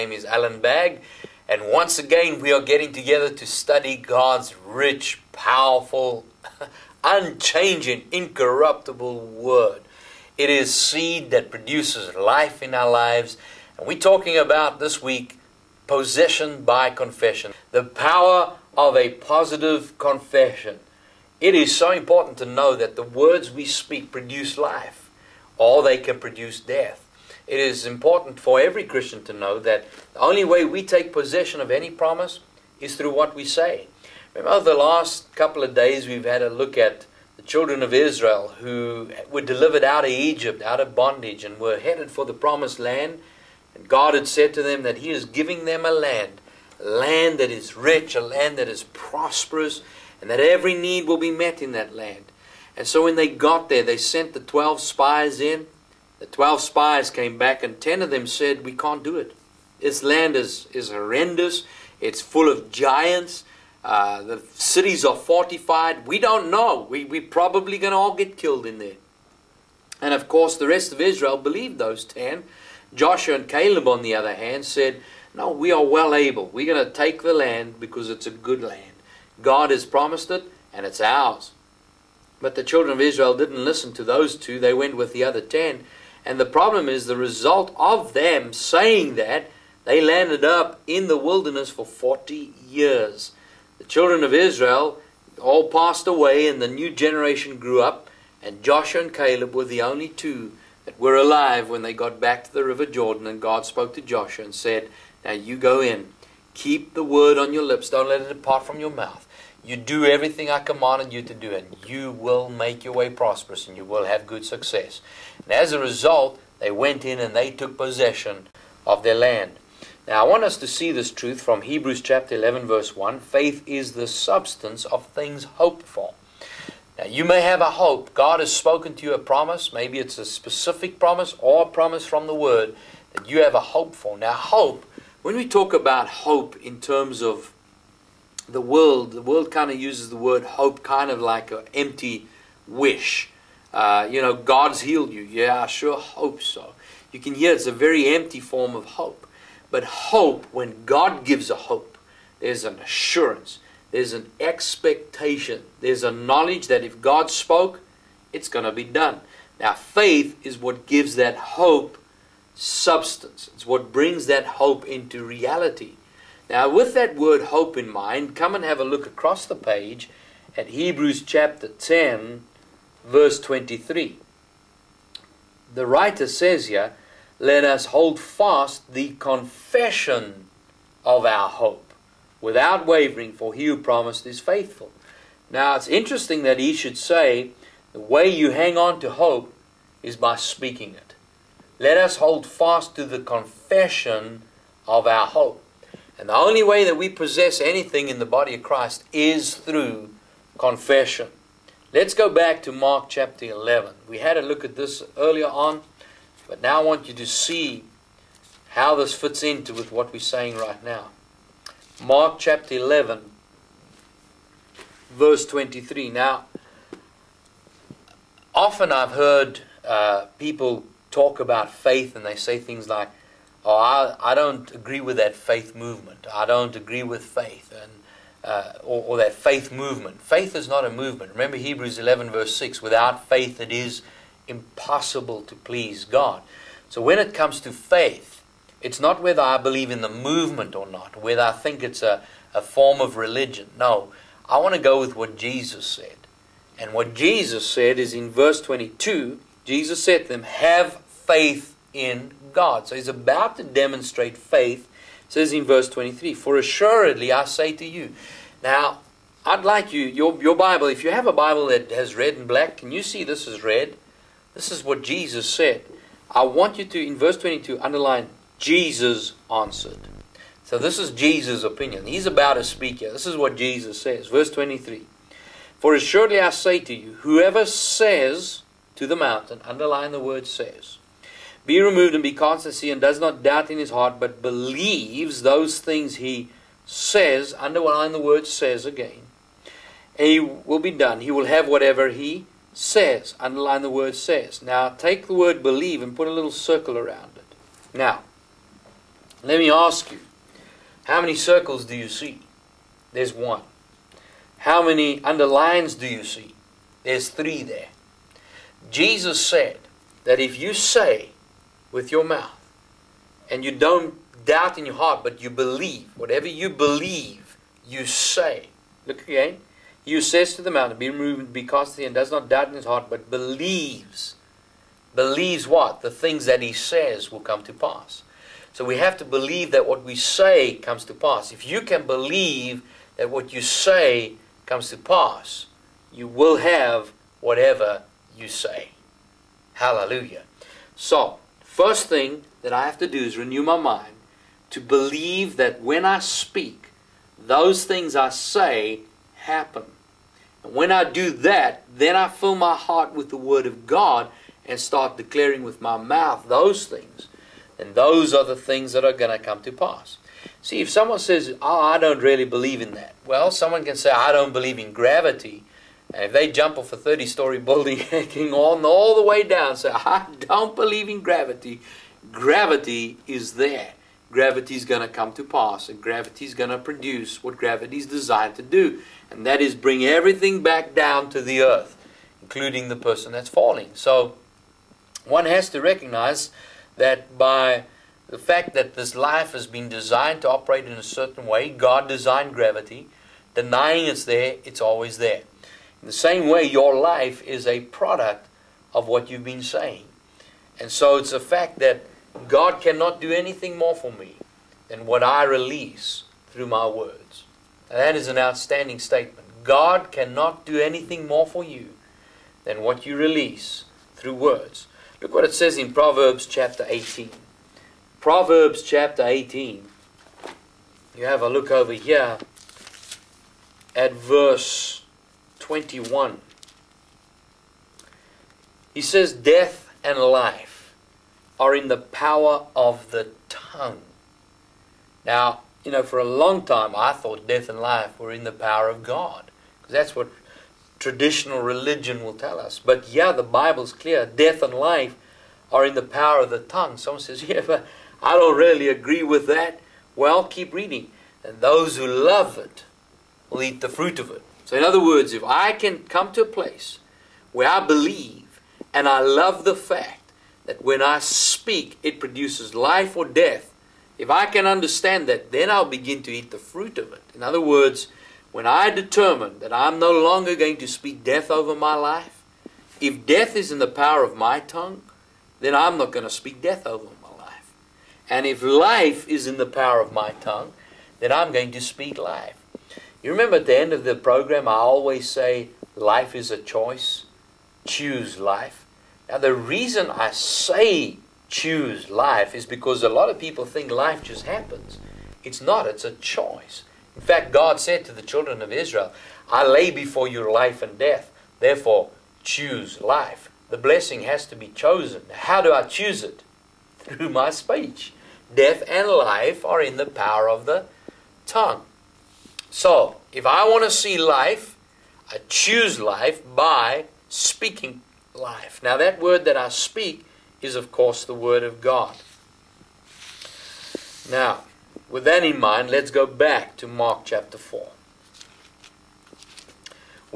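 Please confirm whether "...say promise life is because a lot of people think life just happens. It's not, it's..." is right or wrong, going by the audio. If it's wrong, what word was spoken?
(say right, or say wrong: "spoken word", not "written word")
wrong: "choose", not "promise".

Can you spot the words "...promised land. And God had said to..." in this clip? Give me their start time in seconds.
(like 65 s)
42 s.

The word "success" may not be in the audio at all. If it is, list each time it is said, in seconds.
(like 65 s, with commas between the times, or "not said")
114 s.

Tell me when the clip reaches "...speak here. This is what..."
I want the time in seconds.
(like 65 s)
272 s.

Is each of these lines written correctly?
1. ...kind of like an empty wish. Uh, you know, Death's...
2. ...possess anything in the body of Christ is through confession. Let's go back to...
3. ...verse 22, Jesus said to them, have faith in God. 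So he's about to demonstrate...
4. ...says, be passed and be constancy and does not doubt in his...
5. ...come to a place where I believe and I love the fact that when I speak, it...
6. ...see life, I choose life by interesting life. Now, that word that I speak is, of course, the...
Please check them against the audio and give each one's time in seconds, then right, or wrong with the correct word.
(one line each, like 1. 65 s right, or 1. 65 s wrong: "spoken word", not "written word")
1. 140 s wrong: "God", not "Death"
2. 197 s right
3. 248 s right
4. 280 s wrong: "removed", not "passed"
5. 456 s right
6. 513 s wrong: "speaking", not "interesting".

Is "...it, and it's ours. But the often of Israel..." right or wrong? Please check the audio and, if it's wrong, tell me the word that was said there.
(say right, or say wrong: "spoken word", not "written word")
wrong: "children", not "often".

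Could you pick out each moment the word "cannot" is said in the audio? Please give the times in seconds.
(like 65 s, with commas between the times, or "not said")
402 s, 410 s.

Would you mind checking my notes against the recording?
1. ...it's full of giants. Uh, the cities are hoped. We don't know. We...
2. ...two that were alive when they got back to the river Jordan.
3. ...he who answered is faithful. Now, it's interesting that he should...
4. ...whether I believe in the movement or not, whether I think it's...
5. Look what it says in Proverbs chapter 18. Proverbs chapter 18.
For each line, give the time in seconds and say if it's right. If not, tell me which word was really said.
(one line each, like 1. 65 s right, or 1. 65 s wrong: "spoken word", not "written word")
1. 62 s wrong: "fortified", not "hoped"
2. 100 s right
3. 183 s wrong: "promised", not "answered"
4. 239 s right
5. 415 s right.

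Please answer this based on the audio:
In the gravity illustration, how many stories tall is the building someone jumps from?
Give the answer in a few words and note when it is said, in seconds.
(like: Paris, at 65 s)
30, at 366 s.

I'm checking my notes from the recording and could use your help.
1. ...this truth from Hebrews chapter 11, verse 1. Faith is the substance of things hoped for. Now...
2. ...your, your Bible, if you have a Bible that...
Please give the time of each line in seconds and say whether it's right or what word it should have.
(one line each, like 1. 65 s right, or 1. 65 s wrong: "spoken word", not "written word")
1. 120 s right
2. 260 s right.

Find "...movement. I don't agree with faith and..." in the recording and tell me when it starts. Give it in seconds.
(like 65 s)
225 s.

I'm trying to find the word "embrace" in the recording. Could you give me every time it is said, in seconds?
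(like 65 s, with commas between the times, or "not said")
not said.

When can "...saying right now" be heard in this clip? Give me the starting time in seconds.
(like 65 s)
210 s.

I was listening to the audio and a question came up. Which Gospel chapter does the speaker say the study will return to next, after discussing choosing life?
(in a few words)
Mark 4.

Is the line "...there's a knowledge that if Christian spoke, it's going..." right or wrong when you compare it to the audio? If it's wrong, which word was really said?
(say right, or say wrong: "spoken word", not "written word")
wrong: "God", not "Christian".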